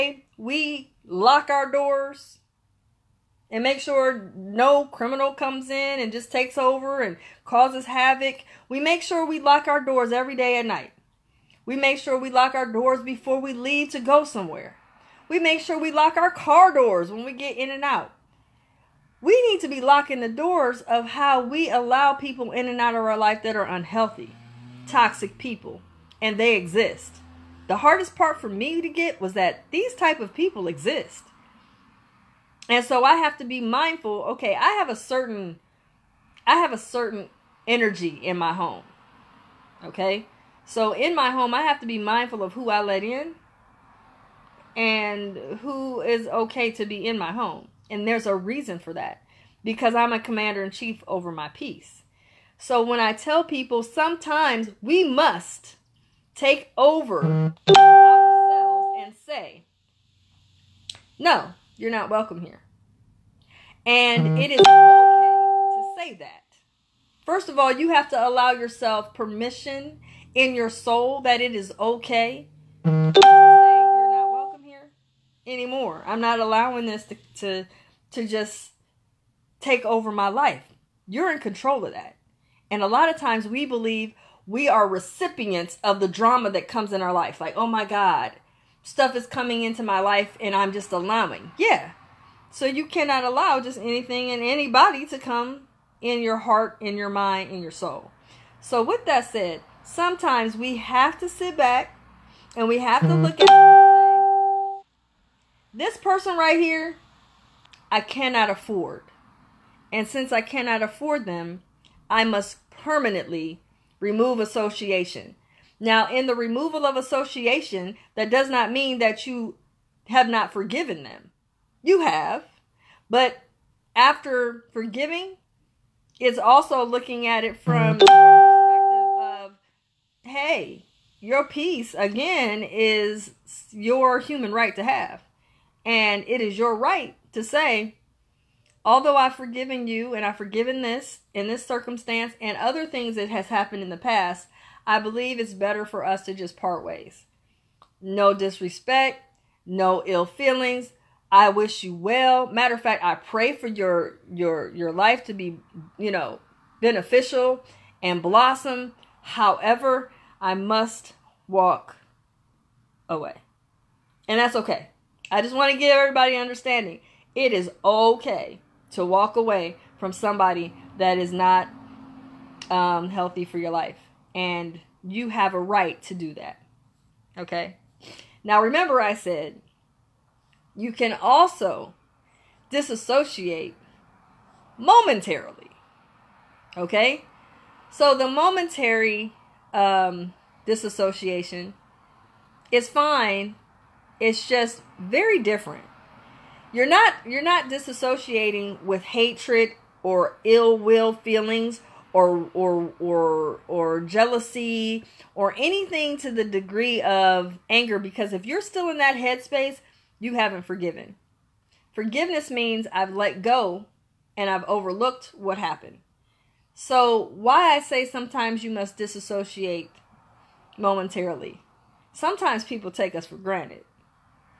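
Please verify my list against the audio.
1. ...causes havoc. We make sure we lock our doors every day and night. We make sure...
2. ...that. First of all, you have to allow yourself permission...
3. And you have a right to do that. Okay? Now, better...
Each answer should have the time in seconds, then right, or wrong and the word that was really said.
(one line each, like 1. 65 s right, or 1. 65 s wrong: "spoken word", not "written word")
1. 7 s right
2. 66 s right
3. 174 s wrong: "remember", not "better".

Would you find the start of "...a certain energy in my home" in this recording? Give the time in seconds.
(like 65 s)
36 s.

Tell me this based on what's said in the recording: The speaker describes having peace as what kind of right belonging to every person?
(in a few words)
Human right.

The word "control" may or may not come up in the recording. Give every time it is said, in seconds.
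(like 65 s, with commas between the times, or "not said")
81 s.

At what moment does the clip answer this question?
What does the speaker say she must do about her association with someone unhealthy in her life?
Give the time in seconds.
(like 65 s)
112 s.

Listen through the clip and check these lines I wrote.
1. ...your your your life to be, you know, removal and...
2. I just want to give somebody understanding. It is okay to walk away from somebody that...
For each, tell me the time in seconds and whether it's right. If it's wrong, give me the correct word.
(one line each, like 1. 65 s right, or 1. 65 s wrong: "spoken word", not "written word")
1. 153 s wrong: "beneficial", not "removal"
2. 165 s wrong: "everybody", not "somebody".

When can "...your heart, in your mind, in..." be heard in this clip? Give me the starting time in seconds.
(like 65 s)
96 s.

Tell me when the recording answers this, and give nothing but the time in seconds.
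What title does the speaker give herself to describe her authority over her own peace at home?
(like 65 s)
50 s.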